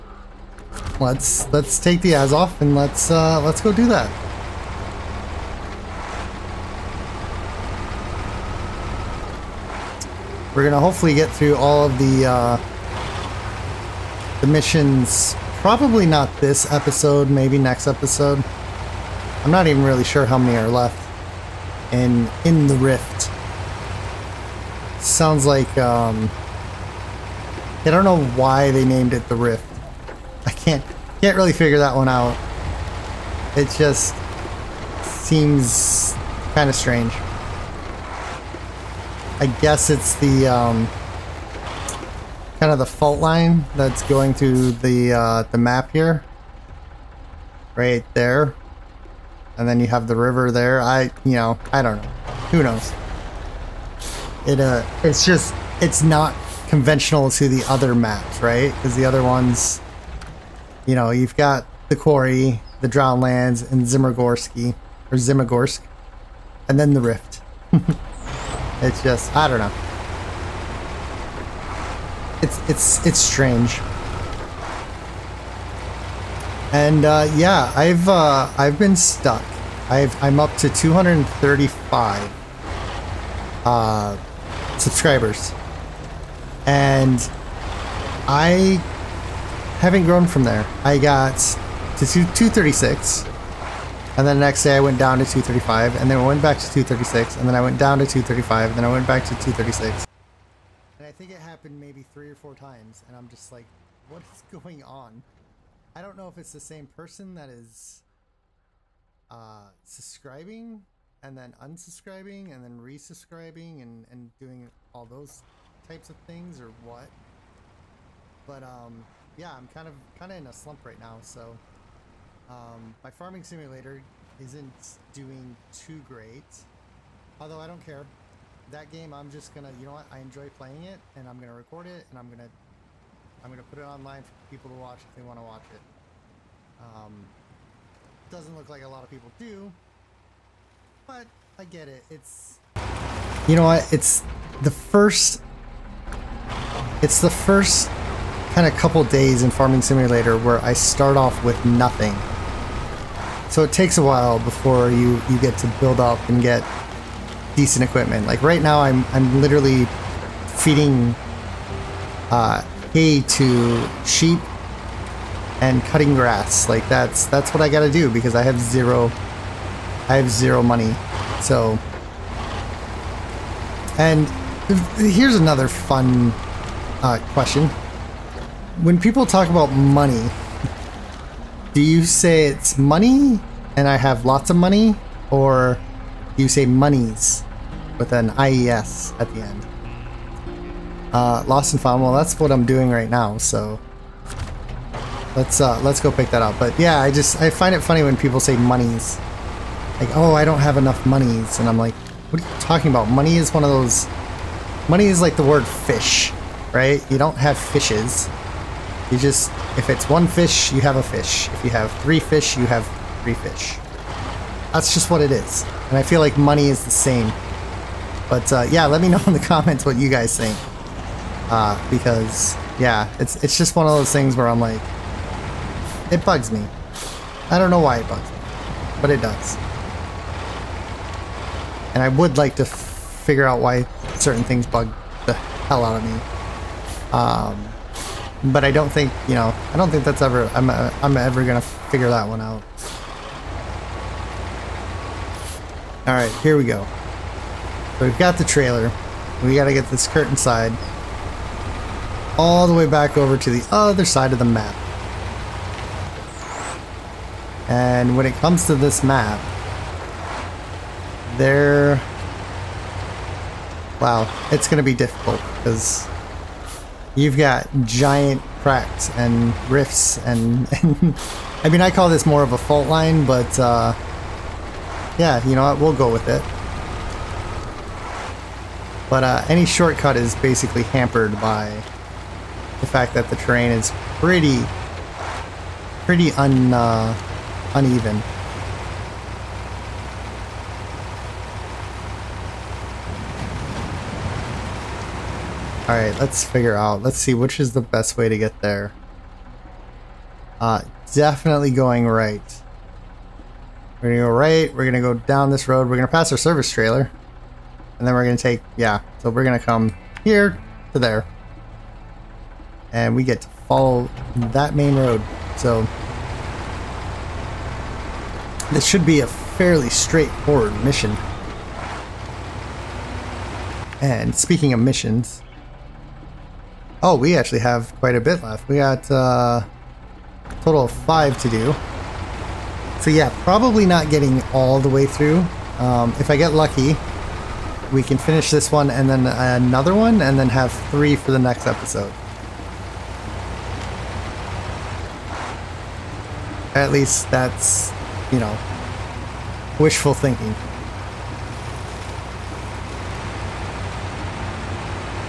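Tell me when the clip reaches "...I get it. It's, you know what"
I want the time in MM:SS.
02:21.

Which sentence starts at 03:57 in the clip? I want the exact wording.
Um, but I don't think you know I don't think that's ever I'm uh, I'm ever gonna figure that one out.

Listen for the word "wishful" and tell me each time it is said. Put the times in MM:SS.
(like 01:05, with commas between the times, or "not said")
05:49.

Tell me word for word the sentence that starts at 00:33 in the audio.
It just seems kind of strange.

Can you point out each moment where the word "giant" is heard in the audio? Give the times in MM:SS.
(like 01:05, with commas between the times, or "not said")
04:27.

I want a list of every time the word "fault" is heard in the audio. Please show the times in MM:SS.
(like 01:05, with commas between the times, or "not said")
00:42, 04:32.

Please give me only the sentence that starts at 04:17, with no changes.
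And when it comes to this map, there.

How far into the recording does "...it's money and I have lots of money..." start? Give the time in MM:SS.
03:02.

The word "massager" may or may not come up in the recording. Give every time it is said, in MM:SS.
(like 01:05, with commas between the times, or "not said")
not said.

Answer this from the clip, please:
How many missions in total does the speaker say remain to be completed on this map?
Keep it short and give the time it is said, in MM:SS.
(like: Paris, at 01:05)
5, at 05:30.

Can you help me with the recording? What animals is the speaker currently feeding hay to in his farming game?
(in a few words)
sheep.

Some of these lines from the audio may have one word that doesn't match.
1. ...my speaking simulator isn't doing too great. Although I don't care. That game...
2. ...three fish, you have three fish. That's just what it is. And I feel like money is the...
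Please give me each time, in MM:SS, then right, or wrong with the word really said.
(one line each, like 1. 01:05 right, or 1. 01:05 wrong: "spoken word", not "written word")
1. 02:03 wrong: "farming", not "speaking"
2. 03:32 right.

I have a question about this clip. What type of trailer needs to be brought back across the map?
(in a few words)
curtain side.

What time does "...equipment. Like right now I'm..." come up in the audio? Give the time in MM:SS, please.
02:37.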